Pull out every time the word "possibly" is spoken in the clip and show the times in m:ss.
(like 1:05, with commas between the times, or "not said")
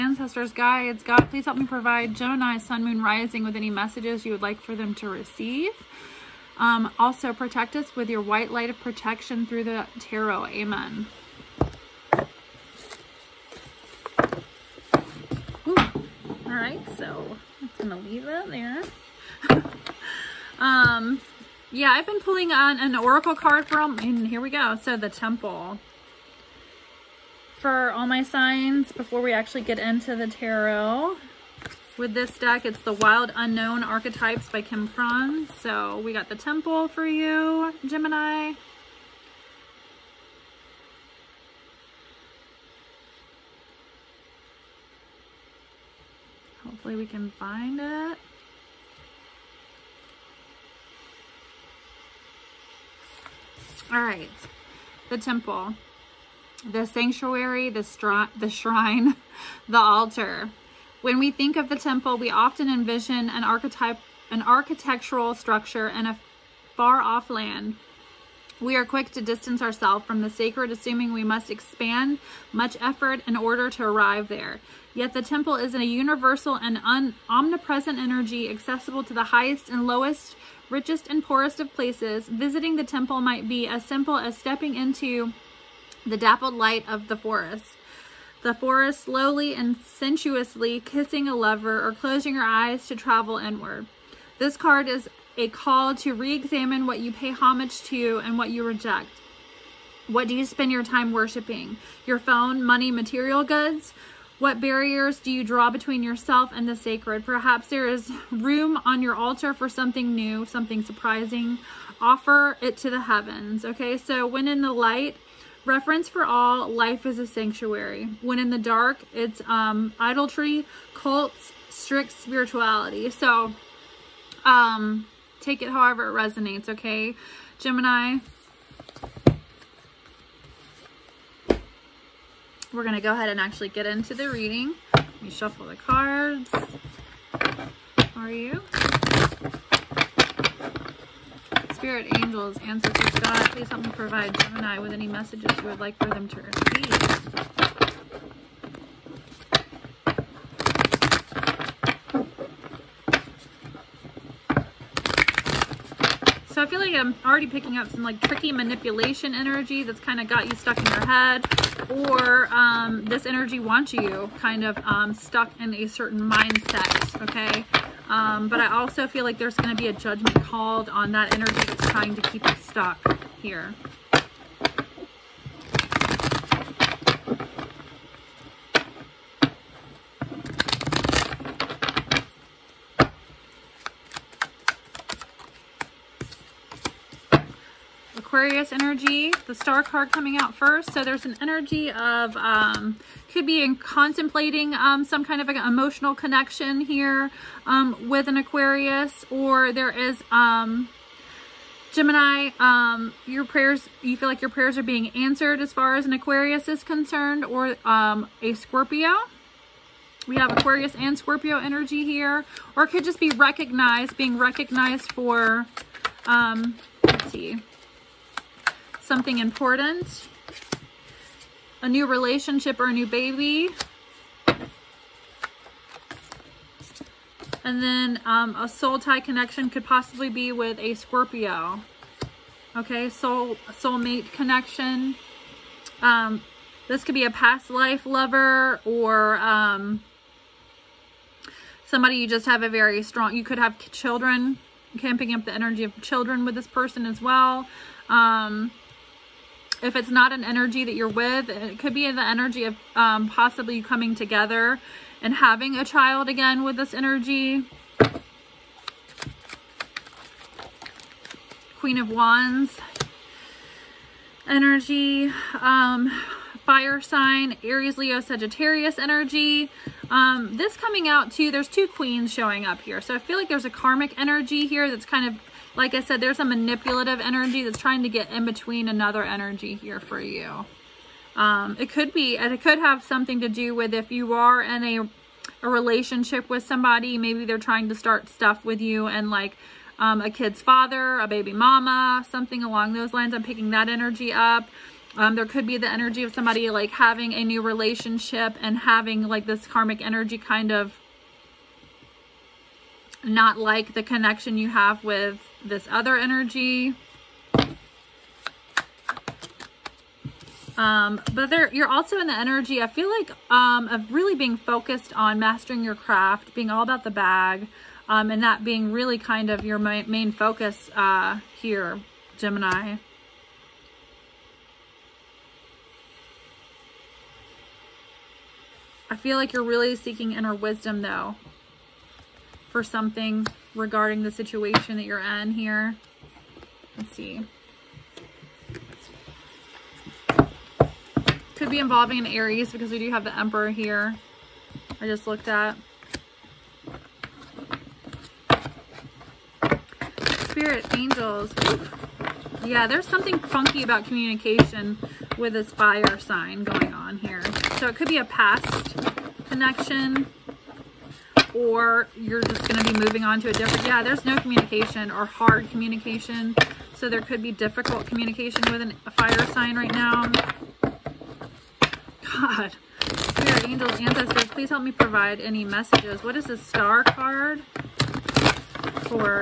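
3:49, 4:13.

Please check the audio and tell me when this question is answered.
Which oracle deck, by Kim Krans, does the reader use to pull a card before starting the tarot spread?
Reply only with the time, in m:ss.
0:32.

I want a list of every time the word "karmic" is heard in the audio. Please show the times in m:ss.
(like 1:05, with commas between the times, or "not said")
4:33, 4:59.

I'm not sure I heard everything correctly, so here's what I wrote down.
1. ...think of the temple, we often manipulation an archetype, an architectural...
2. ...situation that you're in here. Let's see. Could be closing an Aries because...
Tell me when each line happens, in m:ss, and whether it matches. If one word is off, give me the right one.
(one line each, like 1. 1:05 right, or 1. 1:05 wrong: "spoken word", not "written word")
1. 1:01 wrong: "envision", not "manipulation"
2. 5:34 wrong: "involving", not "closing".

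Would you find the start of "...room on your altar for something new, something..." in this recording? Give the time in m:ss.
1:48.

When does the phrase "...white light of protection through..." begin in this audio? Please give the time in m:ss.
0:08.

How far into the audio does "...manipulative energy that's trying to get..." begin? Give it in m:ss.
4:36.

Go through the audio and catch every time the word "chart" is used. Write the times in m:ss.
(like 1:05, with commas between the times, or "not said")
not said.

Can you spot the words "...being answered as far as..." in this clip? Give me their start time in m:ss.
3:24.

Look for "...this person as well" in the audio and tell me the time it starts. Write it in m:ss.
4:06.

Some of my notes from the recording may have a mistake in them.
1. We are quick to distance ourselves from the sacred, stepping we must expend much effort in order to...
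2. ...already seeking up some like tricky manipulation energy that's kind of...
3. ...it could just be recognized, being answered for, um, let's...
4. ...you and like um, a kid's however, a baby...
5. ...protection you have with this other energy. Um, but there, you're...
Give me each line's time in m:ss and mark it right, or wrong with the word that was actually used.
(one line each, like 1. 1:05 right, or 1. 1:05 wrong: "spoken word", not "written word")
1. 1:08 wrong: "assuming", not "stepping"
2. 2:37 wrong: "picking", not "seeking"
3. 3:32 wrong: "recognized", not "answered"
4. 4:48 wrong: "father", not "however"
5. 5:04 wrong: "connection", not "protection".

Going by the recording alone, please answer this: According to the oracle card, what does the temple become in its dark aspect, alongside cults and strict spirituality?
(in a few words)
idolatry.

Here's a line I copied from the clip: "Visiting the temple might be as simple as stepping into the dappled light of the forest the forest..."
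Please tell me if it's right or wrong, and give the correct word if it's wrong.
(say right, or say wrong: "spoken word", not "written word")
right.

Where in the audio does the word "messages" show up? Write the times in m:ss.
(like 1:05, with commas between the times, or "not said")
0:03, 2:25, 6:15.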